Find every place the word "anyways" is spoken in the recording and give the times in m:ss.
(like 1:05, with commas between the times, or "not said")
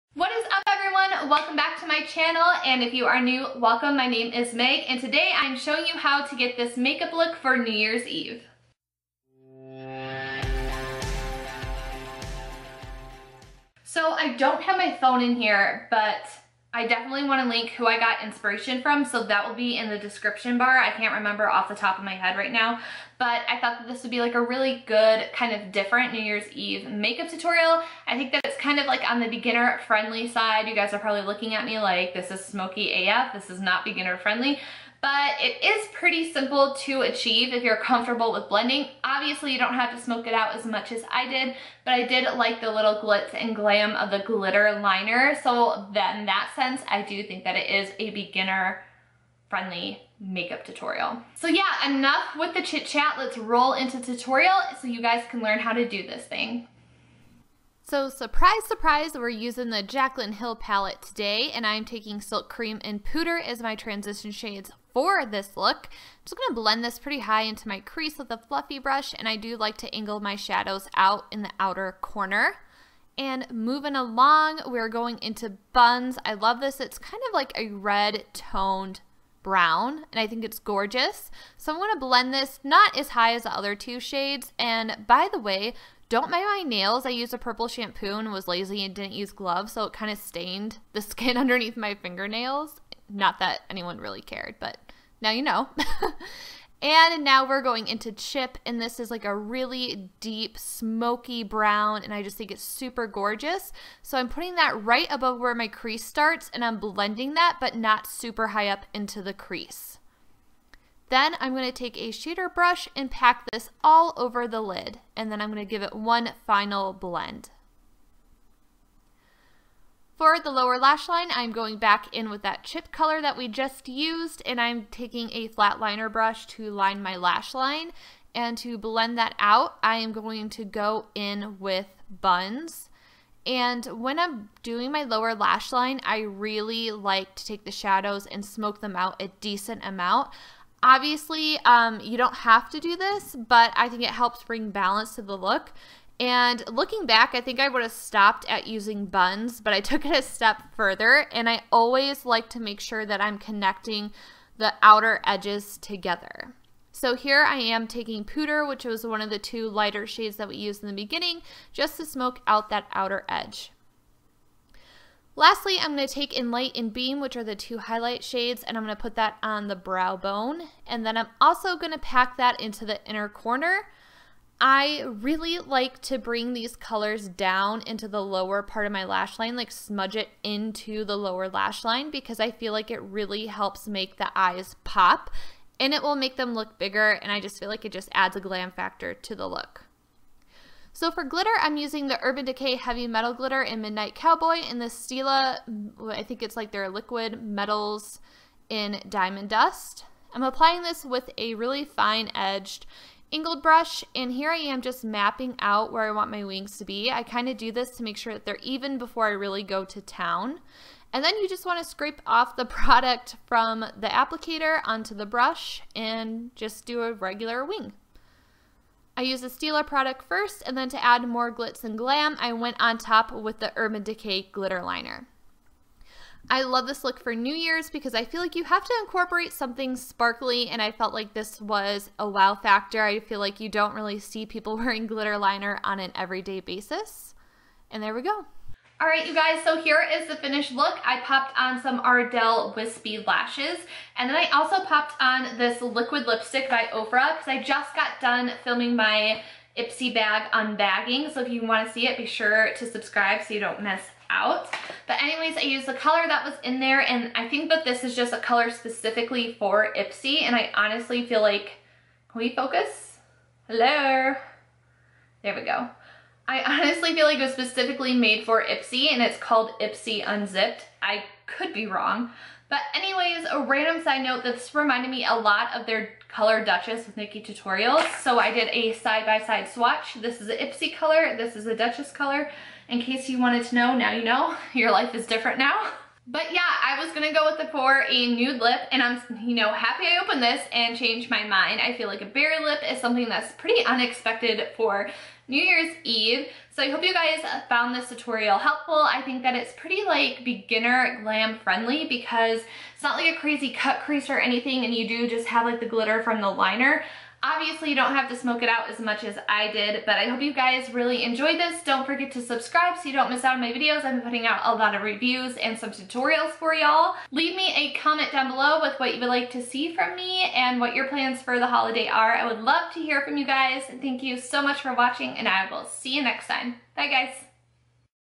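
4:15, 4:32.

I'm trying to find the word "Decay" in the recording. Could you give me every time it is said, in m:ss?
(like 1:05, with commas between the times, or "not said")
3:12, 3:44.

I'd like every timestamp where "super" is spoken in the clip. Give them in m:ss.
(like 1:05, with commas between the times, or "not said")
1:42, 1:48.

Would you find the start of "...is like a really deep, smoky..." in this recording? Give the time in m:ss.
1:38.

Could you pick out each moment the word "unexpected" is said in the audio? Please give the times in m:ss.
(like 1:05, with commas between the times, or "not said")
4:53.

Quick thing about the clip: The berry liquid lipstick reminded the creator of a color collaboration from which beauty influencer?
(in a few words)
NikkieTutorials.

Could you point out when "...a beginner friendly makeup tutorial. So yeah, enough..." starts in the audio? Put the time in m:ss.
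0:47.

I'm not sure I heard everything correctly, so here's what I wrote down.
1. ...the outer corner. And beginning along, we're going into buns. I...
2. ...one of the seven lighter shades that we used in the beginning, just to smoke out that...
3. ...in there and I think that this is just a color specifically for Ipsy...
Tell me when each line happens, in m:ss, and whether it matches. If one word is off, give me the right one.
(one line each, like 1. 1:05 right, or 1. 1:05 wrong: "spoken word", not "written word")
1. 1:11 wrong: "moving", not "beginning"
2. 2:39 wrong: "two", not "seven"
3. 4:16 right.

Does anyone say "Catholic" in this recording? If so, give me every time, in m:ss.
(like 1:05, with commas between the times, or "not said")
not said.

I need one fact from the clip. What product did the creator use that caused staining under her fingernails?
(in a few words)
purple shampoo.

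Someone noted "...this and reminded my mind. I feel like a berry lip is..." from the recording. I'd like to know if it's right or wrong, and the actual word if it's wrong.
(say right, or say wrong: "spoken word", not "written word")
wrong: "changed", not "reminded".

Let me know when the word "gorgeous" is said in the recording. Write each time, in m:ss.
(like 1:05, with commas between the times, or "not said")
1:20, 1:43.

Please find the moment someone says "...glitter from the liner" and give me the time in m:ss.
5:05.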